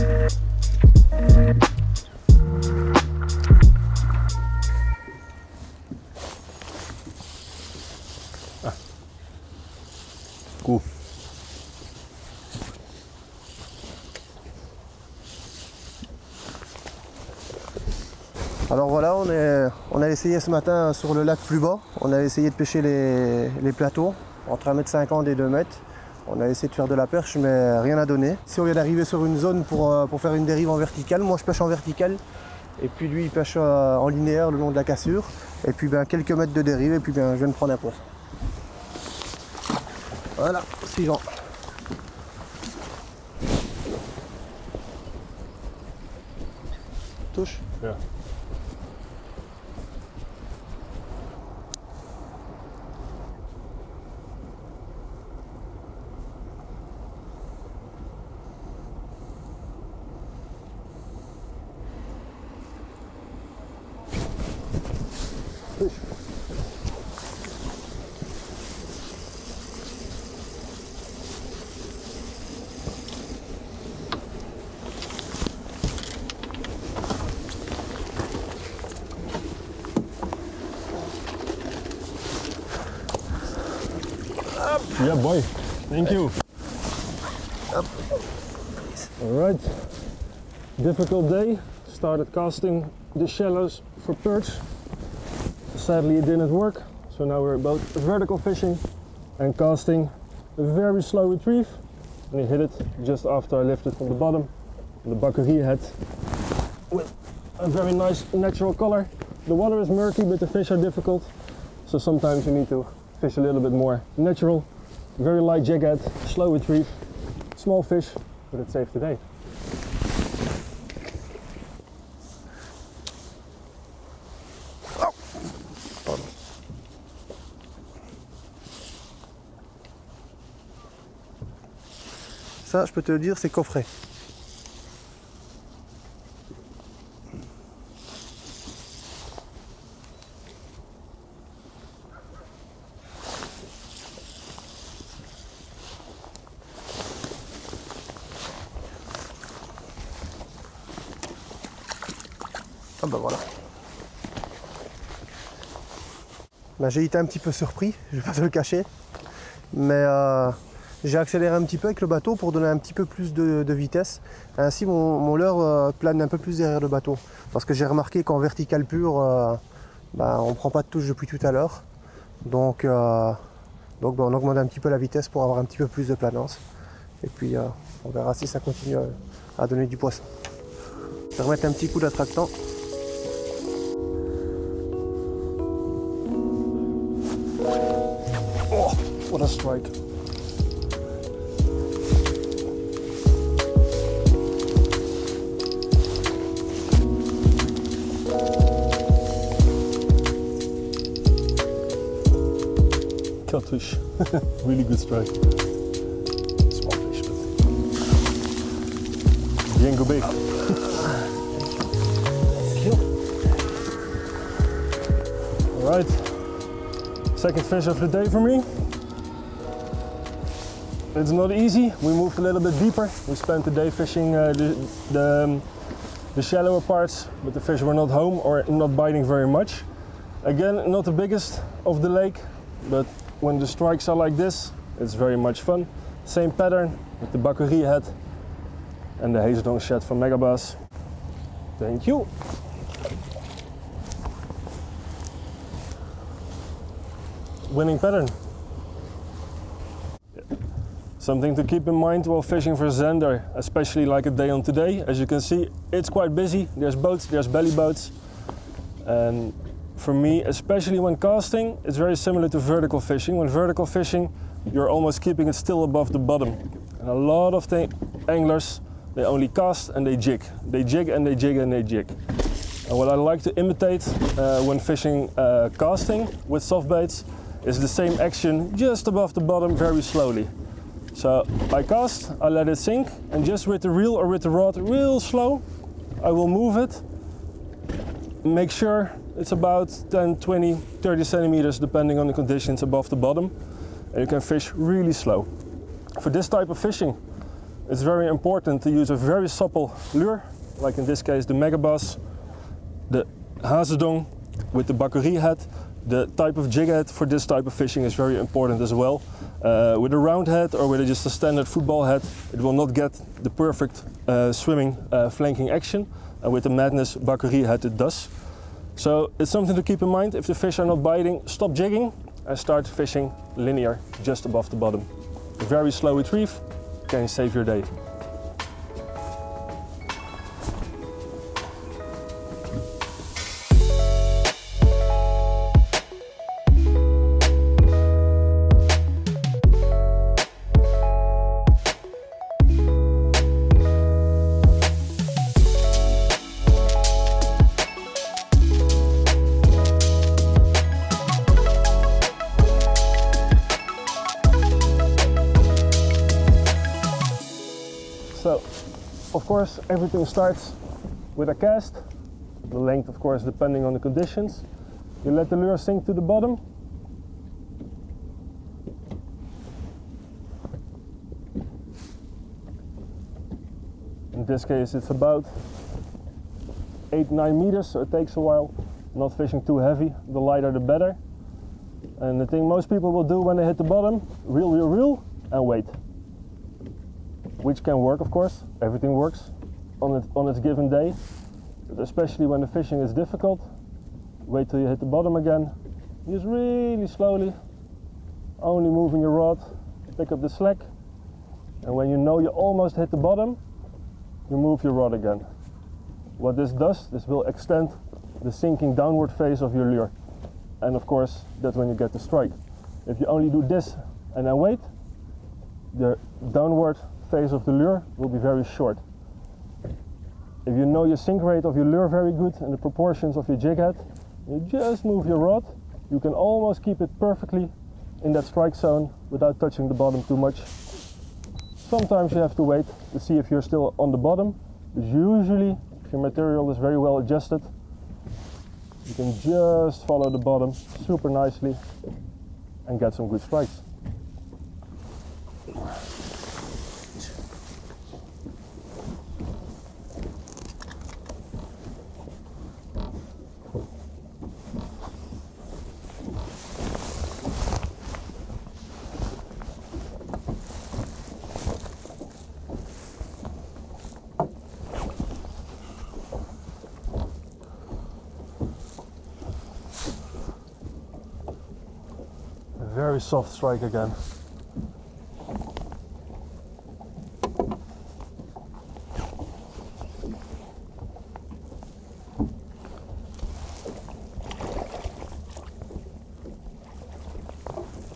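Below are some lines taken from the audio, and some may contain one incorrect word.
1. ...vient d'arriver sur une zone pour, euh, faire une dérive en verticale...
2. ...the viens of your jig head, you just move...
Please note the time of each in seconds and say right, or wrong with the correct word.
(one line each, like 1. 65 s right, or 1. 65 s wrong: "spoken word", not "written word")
1. 28 s right
2. 422 s wrong: "proportions", not "viens".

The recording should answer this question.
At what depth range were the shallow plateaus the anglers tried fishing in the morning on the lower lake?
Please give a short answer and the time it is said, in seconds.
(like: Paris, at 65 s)
1.50 to 2 m, at 24 s.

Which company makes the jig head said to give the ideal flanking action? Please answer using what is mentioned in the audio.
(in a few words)
Madness.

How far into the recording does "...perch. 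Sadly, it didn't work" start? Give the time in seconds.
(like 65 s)
94 s.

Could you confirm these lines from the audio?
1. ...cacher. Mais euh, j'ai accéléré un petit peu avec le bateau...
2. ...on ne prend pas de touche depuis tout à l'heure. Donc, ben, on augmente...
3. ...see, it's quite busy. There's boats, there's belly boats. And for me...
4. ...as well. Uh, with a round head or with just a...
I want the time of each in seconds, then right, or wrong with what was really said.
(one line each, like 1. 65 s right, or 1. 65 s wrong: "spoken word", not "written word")
1. 158 s right
2. 170 s right
3. 255 s right
4. 308 s right.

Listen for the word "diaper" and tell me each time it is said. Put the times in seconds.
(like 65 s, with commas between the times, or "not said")
not said.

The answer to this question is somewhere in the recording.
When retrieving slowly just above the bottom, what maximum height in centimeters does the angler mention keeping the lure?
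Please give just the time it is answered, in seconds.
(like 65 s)
290 s.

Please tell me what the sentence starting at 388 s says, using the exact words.
Everything works on, it, on its given day, but especially when the fishing is difficult.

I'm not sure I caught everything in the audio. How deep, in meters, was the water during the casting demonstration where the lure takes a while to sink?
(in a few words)
8-9 meters.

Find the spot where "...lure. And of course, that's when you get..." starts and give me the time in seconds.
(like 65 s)
409 s.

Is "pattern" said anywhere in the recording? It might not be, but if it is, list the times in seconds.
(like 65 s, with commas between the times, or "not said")
236 s, 247 s.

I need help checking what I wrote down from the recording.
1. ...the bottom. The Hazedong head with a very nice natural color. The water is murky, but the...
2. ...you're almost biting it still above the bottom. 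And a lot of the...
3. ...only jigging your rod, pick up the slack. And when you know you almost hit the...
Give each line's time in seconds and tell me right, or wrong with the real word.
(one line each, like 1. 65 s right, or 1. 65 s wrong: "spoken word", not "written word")
1. 104 s wrong: "Bakuree", not "Hazedong"
2. 264 s wrong: "keeping", not "biting"
3. 398 s wrong: "moving", not "jigging".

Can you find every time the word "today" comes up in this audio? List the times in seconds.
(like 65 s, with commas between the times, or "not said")
118 s, 254 s.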